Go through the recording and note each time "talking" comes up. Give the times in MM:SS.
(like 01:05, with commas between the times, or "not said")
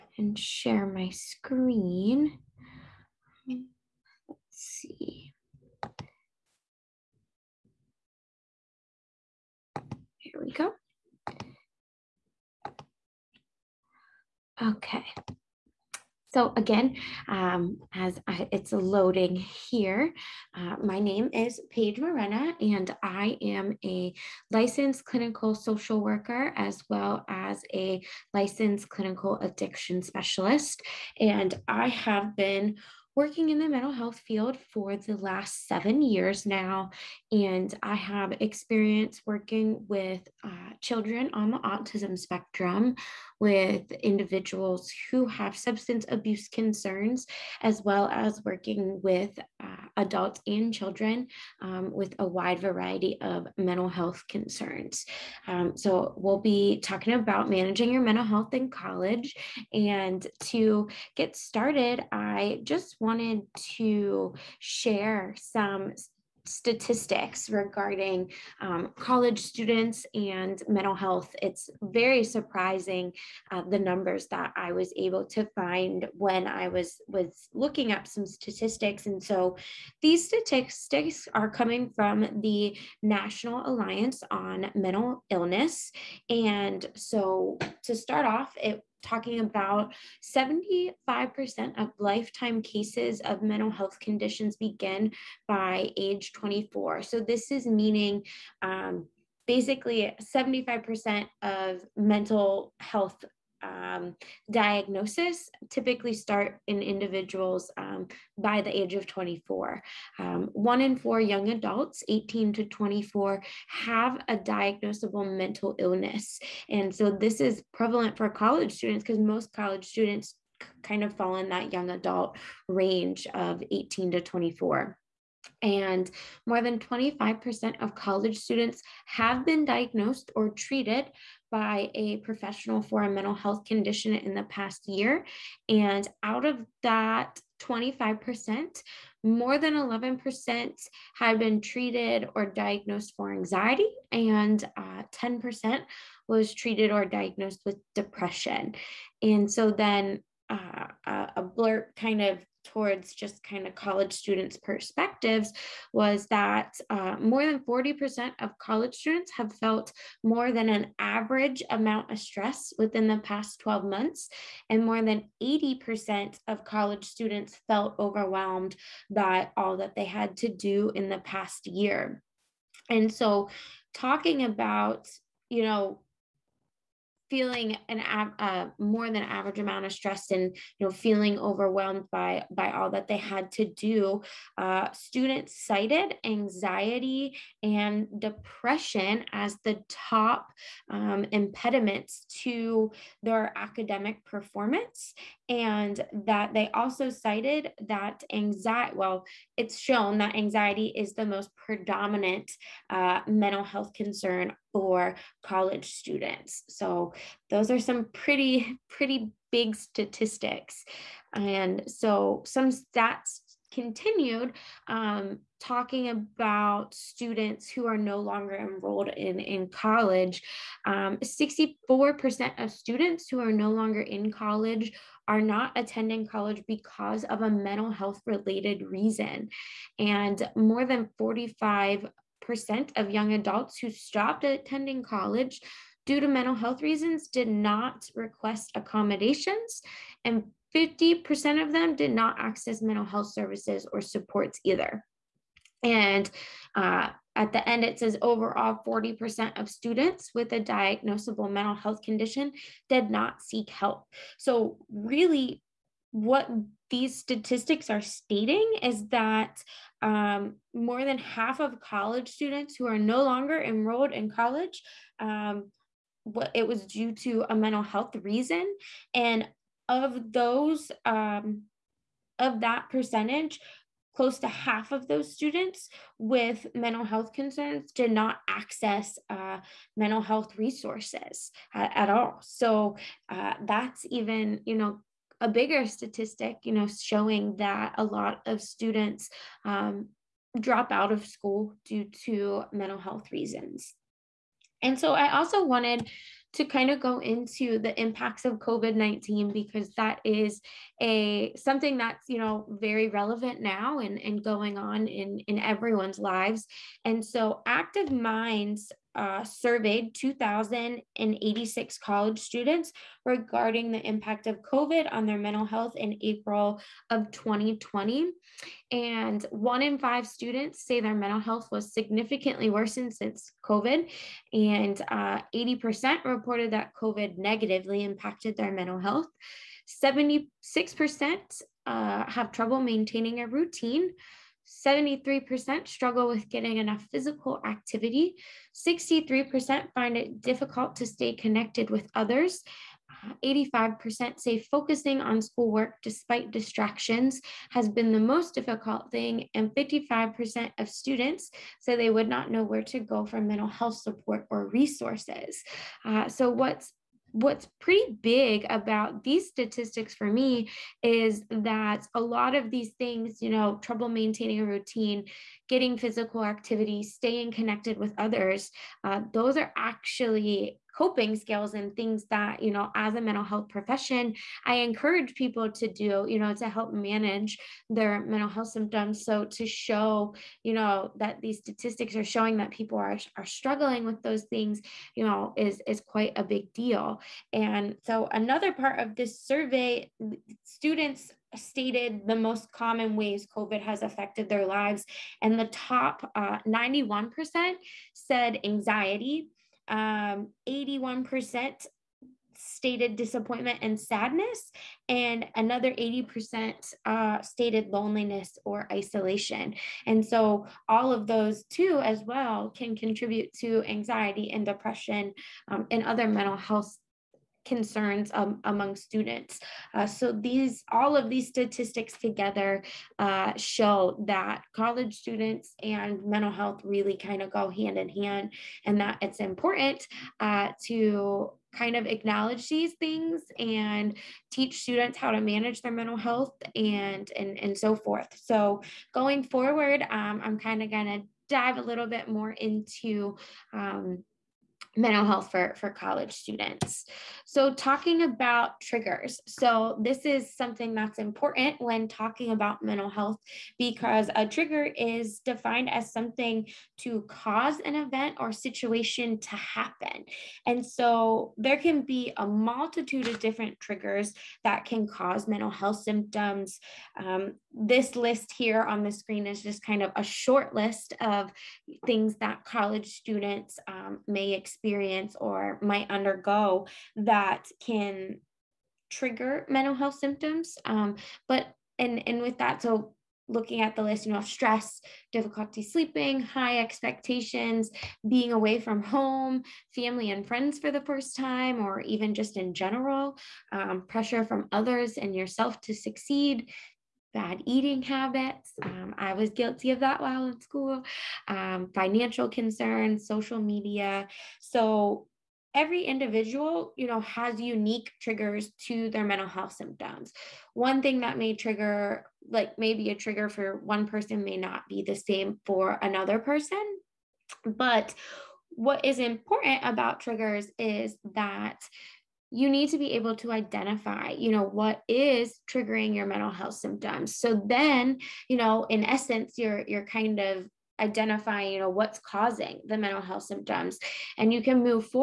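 00:56, 01:29, 02:53, 03:35, 07:27, 07:32.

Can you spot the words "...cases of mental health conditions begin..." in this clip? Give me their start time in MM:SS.
01:32.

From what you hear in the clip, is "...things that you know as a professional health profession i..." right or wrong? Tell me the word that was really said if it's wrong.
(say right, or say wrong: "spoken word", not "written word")
wrong: "mental", not "professional".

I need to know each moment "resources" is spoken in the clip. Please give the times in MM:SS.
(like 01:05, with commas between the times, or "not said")
04:40, 05:54.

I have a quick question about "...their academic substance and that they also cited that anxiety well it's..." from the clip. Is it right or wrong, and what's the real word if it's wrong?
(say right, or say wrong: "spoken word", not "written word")
wrong: "performance", not "substance".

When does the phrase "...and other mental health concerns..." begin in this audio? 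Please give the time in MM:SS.
06:55.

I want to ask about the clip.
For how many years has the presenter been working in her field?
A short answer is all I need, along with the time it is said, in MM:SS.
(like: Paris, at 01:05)
7, at 00:35.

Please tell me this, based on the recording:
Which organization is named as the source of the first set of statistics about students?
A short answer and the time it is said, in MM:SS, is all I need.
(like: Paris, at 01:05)
National Alliance on Mental Illness, at 01:23.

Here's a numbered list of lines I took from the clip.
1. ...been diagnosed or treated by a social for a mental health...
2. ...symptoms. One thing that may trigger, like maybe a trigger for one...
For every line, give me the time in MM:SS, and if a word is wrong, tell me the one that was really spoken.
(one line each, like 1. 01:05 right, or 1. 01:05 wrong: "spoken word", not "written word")
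1. 02:09 wrong: "professional", not "social"
2. 08:29 right.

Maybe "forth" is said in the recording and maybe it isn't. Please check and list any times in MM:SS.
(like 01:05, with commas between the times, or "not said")
07:17.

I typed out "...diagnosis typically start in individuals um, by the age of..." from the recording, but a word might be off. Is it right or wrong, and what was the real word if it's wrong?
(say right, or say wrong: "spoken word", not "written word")
right.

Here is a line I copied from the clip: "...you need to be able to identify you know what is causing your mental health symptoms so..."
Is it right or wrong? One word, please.
wrong.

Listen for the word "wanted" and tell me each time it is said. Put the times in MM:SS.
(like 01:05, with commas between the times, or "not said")
01:02, 04:55.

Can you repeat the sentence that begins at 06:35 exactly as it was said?
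And the top uh, 91% said anxiety, um, 81% stated disappointment and sadness, and another 80% uh, stated loneliness or isolation.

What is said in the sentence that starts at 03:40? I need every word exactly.
Um, 64% of students who are no longer in college are not attending college because of a mental health related reason.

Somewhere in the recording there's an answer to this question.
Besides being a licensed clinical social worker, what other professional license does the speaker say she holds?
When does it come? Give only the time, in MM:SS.
00:28.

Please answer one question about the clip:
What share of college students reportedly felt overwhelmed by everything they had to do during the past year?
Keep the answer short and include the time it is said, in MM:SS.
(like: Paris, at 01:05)
more than 80%, at 02:44.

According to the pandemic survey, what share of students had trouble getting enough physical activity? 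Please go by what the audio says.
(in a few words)
73%.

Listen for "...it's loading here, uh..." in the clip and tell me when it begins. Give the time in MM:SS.
00:18.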